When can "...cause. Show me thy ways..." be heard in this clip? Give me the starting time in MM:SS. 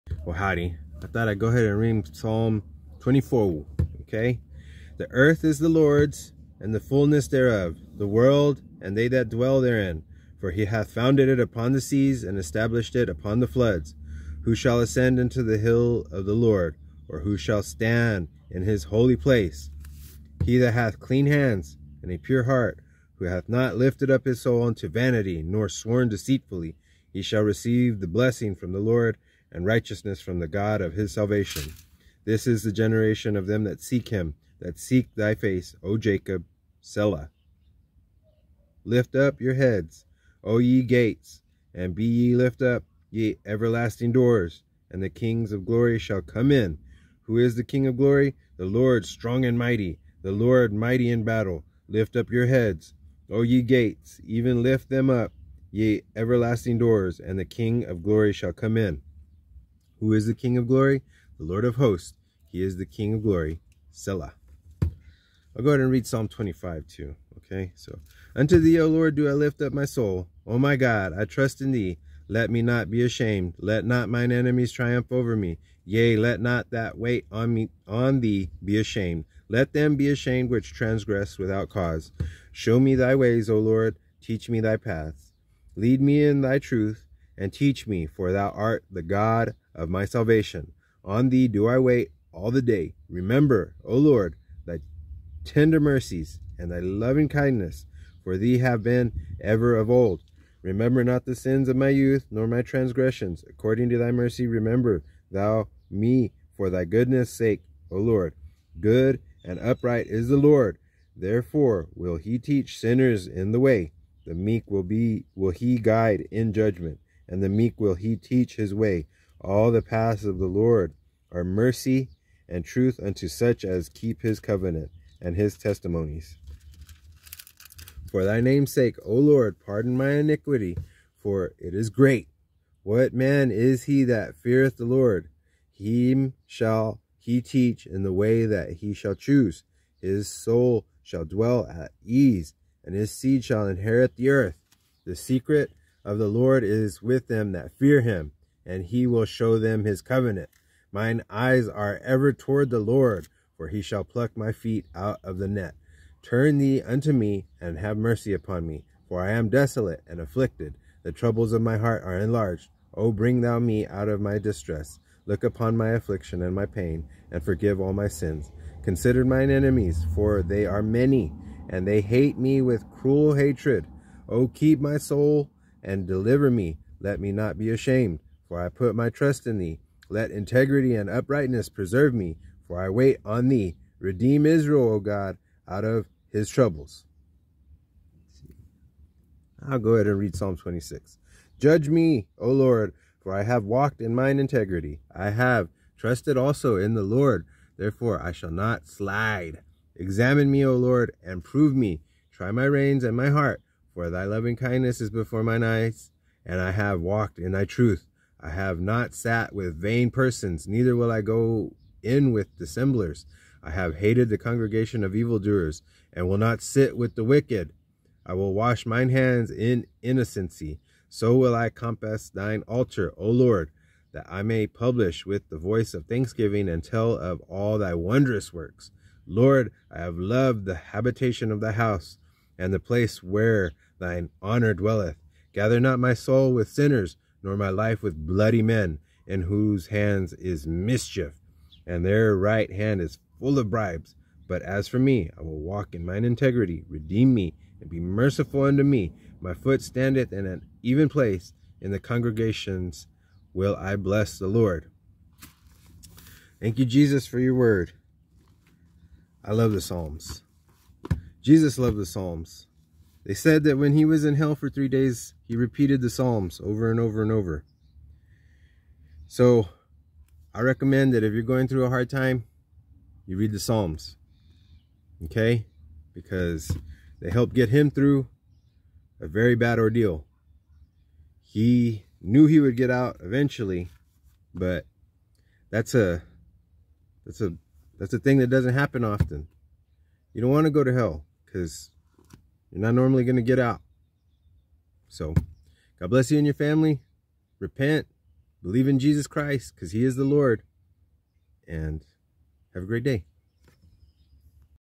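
01:21.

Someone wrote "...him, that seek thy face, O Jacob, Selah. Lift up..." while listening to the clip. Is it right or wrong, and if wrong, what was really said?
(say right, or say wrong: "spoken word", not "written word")
right.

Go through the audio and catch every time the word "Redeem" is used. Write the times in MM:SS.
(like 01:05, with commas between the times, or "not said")
03:03, 04:06.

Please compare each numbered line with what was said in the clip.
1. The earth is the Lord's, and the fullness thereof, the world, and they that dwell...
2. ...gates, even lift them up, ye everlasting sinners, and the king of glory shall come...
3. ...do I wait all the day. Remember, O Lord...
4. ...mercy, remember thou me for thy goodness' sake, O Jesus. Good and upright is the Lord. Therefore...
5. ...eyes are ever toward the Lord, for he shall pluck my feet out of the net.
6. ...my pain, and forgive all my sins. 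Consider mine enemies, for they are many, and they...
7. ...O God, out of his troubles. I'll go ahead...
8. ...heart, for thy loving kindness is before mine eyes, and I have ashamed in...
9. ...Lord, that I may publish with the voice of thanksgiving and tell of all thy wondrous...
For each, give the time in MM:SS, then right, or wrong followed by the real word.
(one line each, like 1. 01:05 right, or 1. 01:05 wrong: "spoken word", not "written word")
1. 00:04 right
2. 00:53 wrong: "doors", not "sinners"
3. 01:31 right
4. 01:44 wrong: "Lord", not "Jesus"
5. 02:31 right
6. 02:46 right
7. 03:04 right
8. 03:23 wrong: "walked", not "ashamed"
9. 03:43 right.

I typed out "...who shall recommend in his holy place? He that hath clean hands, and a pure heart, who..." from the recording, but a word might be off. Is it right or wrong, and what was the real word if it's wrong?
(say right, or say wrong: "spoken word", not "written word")
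wrong: "stand", not "recommend".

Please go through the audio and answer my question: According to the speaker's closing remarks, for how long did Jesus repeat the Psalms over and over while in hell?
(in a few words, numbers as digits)
3 days.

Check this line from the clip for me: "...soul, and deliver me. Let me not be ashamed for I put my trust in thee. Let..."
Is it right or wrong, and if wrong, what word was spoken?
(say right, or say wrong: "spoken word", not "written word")
right.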